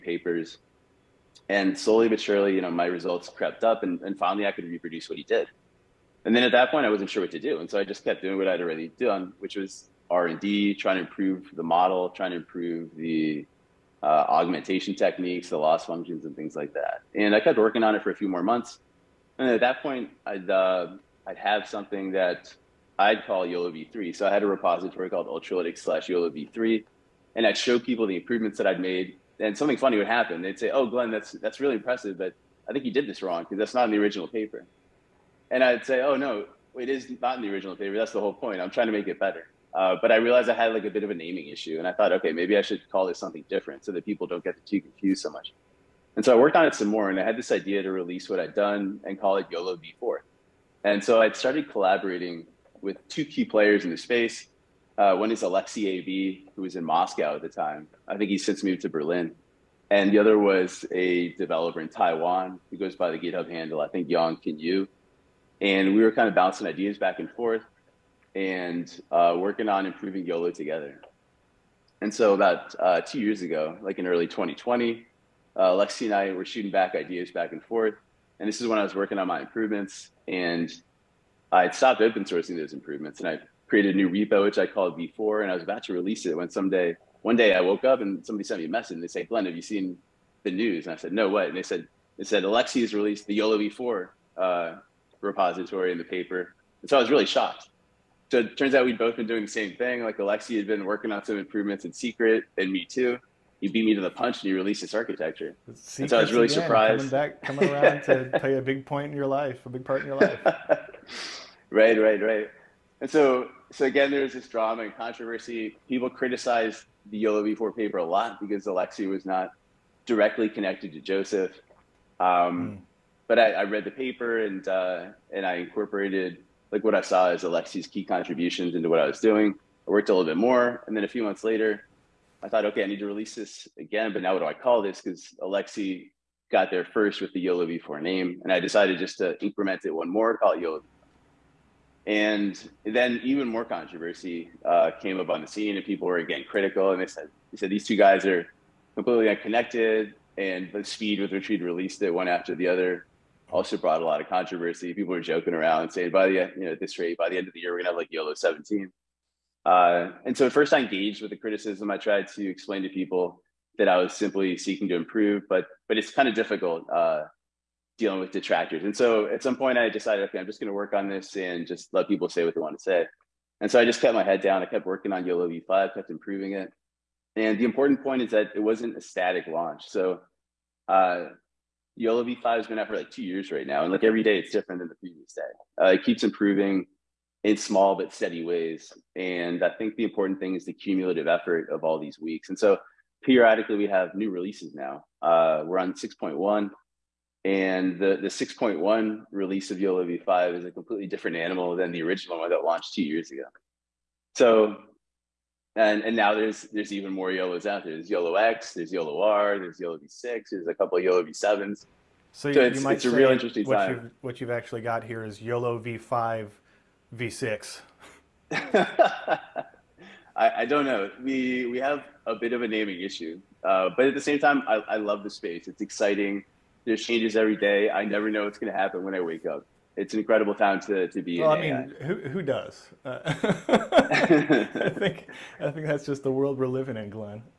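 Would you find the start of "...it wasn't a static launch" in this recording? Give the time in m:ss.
2:58.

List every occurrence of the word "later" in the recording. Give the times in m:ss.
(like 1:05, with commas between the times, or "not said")
2:11.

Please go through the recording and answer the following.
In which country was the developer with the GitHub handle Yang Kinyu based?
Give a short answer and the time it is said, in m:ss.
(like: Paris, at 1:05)
Taiwan, at 1:01.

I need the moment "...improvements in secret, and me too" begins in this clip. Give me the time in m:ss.
1:41.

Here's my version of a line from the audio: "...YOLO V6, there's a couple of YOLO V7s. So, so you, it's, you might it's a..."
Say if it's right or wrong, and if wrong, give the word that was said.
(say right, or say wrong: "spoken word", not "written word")
right.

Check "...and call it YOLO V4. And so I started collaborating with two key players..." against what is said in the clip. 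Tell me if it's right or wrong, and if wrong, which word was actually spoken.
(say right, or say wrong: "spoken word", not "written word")
right.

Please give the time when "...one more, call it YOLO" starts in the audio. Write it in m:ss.
2:19.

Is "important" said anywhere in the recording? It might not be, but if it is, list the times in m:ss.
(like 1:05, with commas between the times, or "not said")
2:57, 3:10.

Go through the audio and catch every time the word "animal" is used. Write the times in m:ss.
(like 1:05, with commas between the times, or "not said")
3:21.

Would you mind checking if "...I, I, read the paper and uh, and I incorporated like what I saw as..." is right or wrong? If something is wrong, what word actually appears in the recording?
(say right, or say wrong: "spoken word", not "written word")
right.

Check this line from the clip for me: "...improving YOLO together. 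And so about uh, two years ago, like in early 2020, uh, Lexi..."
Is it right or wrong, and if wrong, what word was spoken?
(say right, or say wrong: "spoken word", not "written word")
right.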